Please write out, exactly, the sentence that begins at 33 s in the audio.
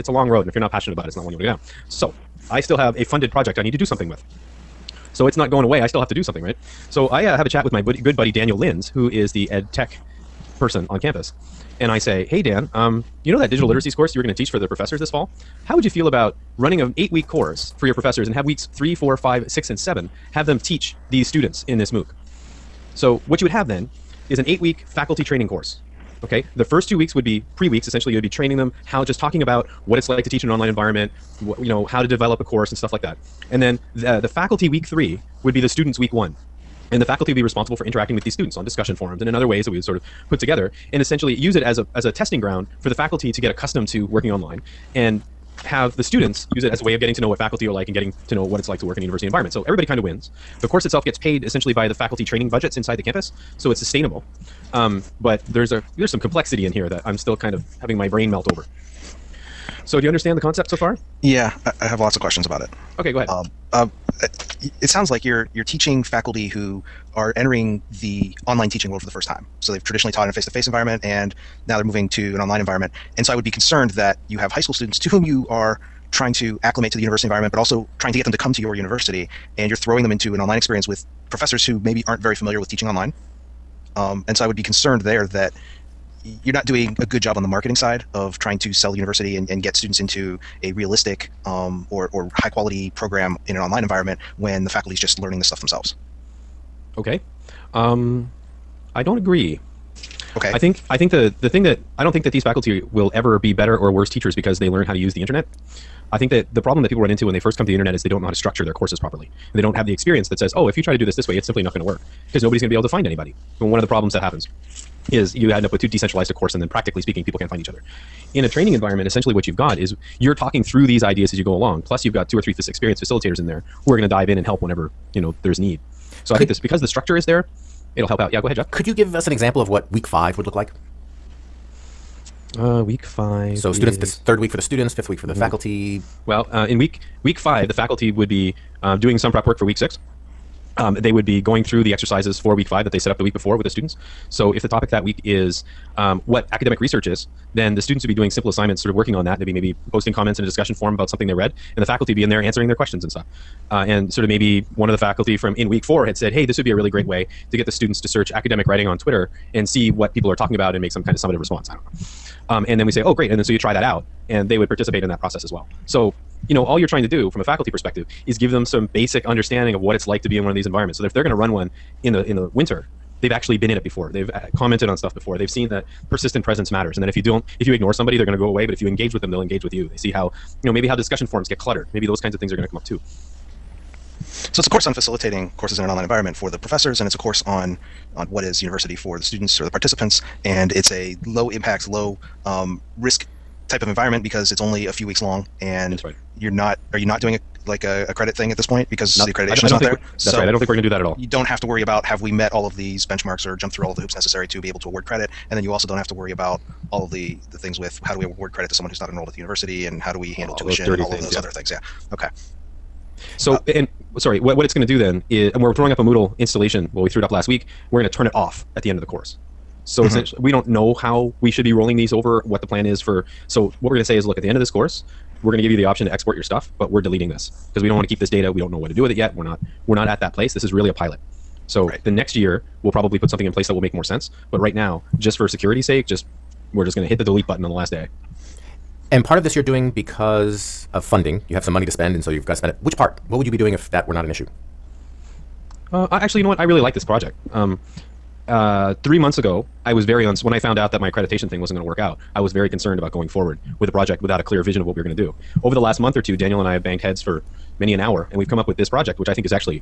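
And then the, the faculty week three would be the students week one.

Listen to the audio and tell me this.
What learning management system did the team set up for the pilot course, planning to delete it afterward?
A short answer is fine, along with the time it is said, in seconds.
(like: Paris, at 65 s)
Moodle, at 216 s.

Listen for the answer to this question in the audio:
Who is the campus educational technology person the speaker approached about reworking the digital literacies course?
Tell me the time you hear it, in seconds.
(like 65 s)
8 s.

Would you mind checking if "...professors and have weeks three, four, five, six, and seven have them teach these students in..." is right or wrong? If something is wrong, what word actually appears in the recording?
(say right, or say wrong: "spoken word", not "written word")
right.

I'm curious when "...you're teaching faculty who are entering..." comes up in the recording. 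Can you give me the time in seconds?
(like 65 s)
65 s.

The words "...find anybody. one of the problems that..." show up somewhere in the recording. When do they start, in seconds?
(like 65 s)
112 s.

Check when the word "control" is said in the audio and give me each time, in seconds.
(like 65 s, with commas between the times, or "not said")
not said.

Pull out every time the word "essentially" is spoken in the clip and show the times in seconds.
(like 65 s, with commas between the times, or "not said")
27 s, 41 s, 51 s, 119 s, 220 s.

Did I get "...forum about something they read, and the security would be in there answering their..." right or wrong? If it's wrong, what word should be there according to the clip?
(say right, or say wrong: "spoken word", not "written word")
wrong: "faculty", not "security".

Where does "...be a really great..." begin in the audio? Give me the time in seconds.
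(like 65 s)
156 s.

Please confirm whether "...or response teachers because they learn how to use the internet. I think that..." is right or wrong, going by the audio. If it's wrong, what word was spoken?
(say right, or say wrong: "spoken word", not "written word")
wrong: "worse", not "response".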